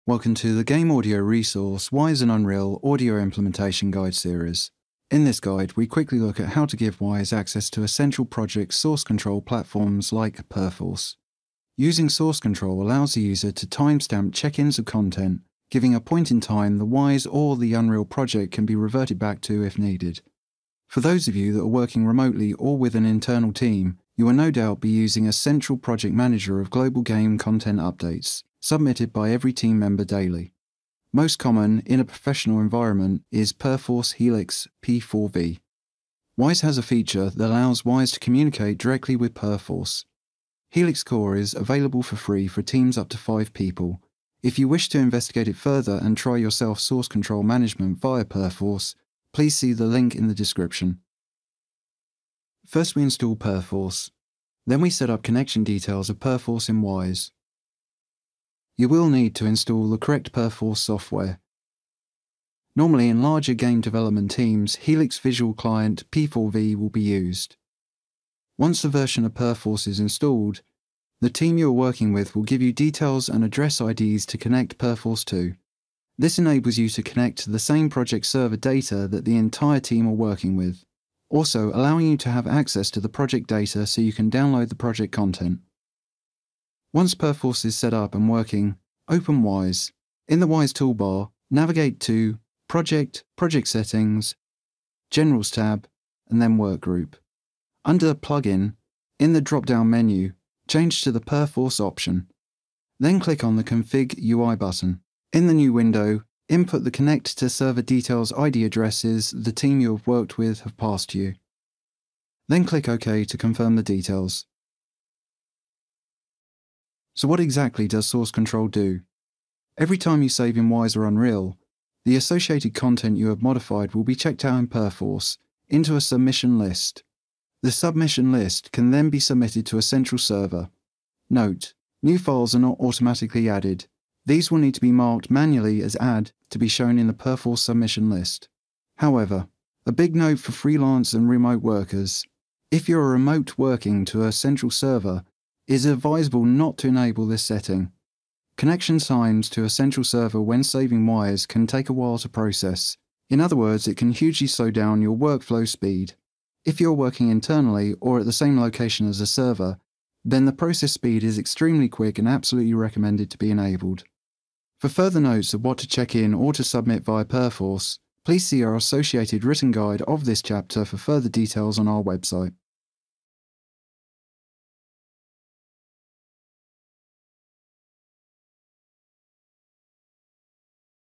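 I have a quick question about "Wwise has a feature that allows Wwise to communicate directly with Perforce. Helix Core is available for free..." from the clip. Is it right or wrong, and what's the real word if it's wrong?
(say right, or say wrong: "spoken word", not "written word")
right.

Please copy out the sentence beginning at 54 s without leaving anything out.
Then we set up connection details of Perforce in Wwise you will need to install the correct Perforce software.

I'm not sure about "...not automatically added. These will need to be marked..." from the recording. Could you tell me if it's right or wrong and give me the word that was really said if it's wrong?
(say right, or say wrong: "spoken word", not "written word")
right.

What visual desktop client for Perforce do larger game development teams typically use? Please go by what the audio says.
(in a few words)
Helix Visual Client P4V.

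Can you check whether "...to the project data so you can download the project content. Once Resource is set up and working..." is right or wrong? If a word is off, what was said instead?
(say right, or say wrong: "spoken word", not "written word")
wrong: "Perforce", not "Resource".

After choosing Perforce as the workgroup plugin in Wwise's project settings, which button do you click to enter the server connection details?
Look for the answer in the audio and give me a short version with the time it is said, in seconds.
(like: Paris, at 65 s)
Config UI, at 103 s.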